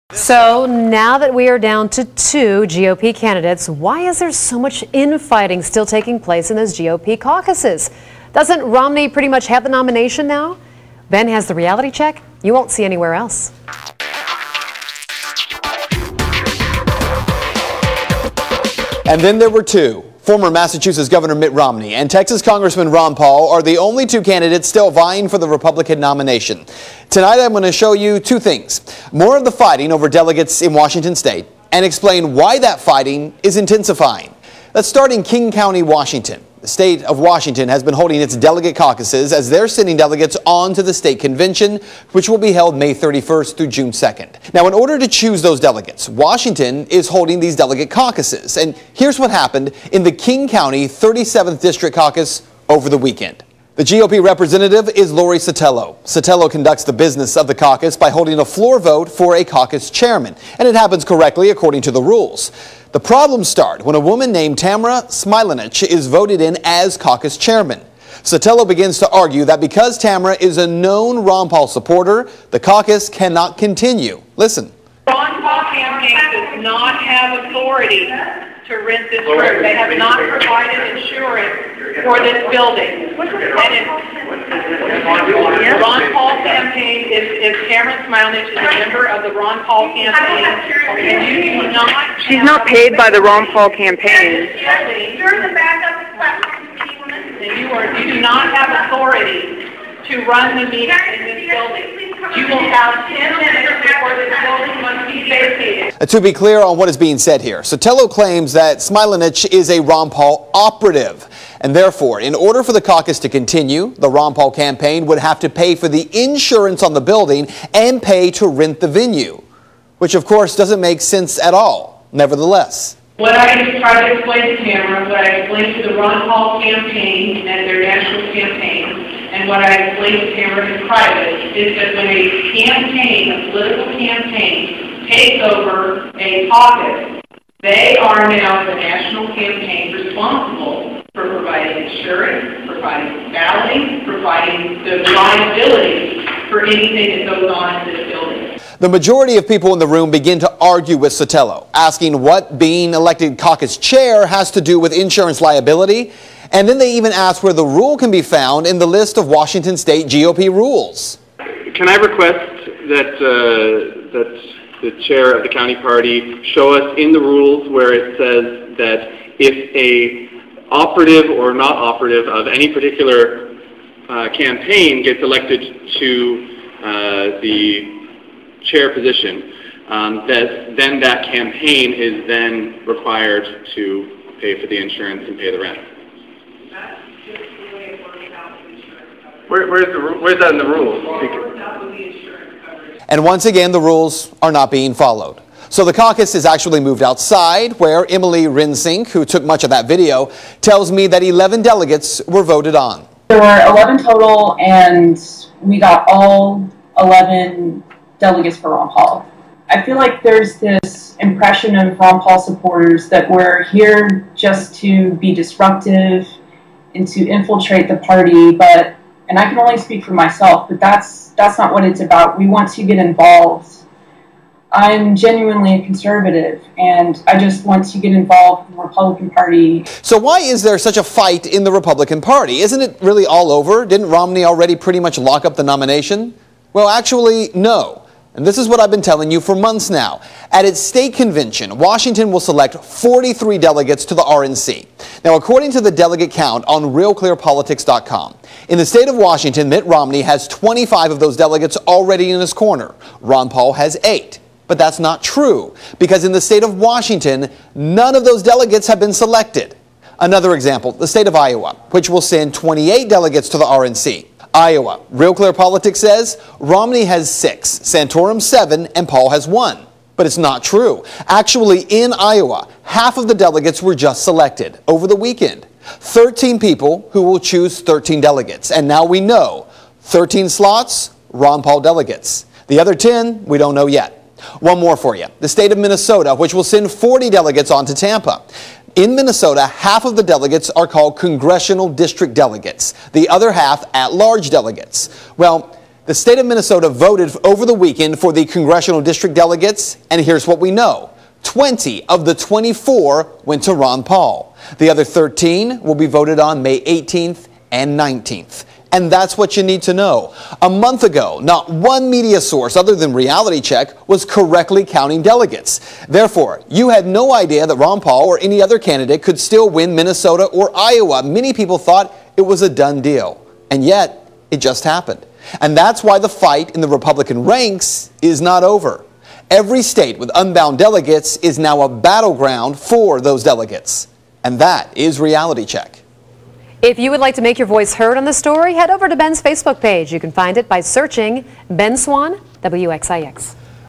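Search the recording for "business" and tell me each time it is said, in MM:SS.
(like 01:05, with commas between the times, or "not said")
00:56.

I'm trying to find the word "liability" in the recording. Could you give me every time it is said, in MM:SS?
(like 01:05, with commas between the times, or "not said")
02:25, 02:35.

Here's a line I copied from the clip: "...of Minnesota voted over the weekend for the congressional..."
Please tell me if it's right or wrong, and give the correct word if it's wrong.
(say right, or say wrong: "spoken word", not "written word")
right.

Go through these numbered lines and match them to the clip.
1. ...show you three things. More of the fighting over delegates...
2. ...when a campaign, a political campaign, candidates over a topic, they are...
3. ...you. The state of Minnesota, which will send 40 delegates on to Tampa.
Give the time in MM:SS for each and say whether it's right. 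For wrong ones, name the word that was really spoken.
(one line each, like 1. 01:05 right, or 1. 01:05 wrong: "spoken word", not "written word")
1. 00:27 wrong: "two", not "three"
2. 02:11 wrong: "takes", not "candidates"
3. 04:45 right.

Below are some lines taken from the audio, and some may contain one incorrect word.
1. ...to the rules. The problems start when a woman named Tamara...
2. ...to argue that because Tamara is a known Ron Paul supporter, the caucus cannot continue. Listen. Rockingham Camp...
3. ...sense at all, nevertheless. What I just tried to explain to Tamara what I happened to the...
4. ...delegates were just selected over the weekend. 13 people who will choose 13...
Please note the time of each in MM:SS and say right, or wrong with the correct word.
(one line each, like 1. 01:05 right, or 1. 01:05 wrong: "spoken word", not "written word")
1. 01:01 right
2. 01:08 right
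3. 02:01 wrong: "explained", not "happened"
4. 04:33 right.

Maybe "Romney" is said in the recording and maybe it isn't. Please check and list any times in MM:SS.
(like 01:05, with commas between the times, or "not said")
00:08, 00:21, 03:54, 04:09, 04:26.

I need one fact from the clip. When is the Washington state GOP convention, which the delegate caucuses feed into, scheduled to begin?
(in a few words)
May 31st.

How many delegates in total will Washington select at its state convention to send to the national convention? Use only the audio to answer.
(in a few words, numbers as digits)
43.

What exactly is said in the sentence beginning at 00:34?
Let's start in King County, Washington.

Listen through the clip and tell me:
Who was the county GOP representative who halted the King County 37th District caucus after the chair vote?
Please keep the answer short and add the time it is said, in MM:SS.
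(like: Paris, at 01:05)
Lori Sotelo, at 00:55.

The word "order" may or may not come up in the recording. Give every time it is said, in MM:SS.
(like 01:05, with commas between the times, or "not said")
00:44, 01:52.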